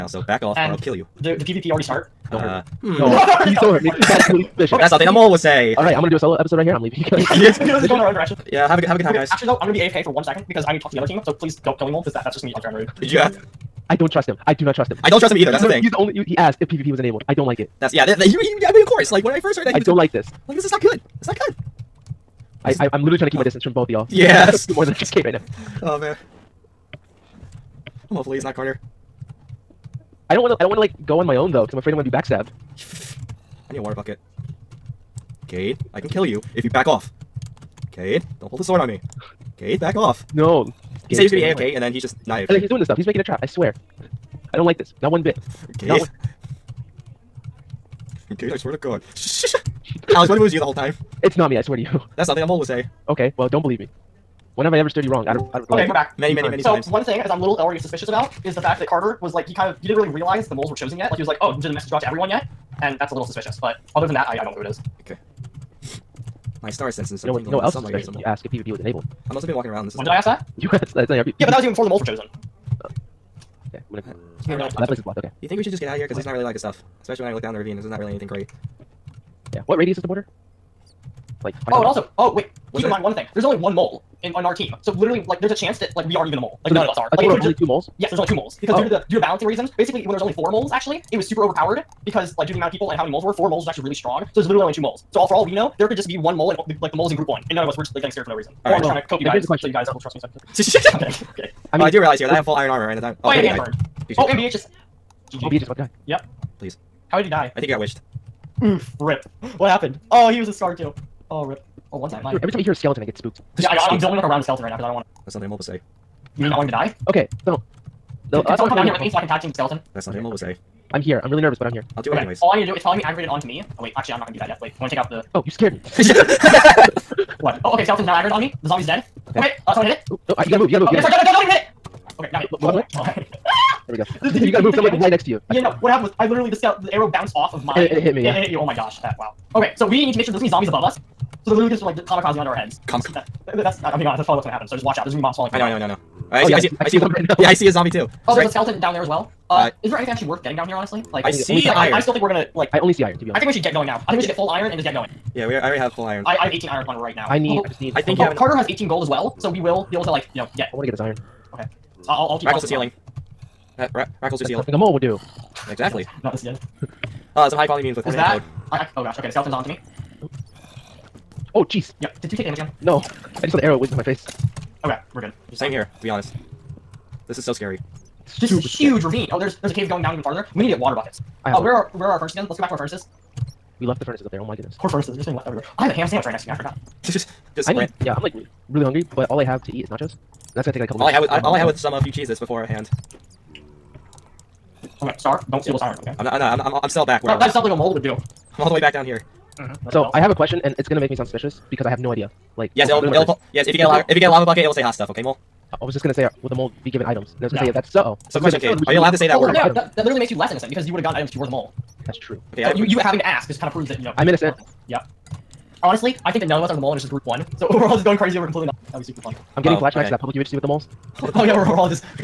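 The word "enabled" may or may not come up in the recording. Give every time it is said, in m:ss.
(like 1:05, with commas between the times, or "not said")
0:16, 1:08.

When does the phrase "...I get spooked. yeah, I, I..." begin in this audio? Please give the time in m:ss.
1:53.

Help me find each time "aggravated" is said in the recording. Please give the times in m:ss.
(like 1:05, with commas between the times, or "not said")
2:03, 2:08.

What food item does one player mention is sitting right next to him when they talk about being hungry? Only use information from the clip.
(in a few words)
ham sandwich.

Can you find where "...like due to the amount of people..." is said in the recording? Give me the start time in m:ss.
1:32.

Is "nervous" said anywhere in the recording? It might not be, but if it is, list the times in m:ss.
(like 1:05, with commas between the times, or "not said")
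2:01.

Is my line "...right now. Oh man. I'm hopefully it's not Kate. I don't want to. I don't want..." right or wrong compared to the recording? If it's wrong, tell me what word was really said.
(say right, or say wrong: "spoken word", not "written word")
wrong: "Carter", not "Kate".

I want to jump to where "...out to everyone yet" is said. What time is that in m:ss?
1:01.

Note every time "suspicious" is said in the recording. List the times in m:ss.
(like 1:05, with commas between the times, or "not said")
0:04, 0:57, 1:03, 1:07, 3:21.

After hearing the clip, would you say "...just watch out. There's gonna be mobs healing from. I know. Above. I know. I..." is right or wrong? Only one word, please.
wrong.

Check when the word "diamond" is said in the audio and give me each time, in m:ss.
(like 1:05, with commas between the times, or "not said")
1:42.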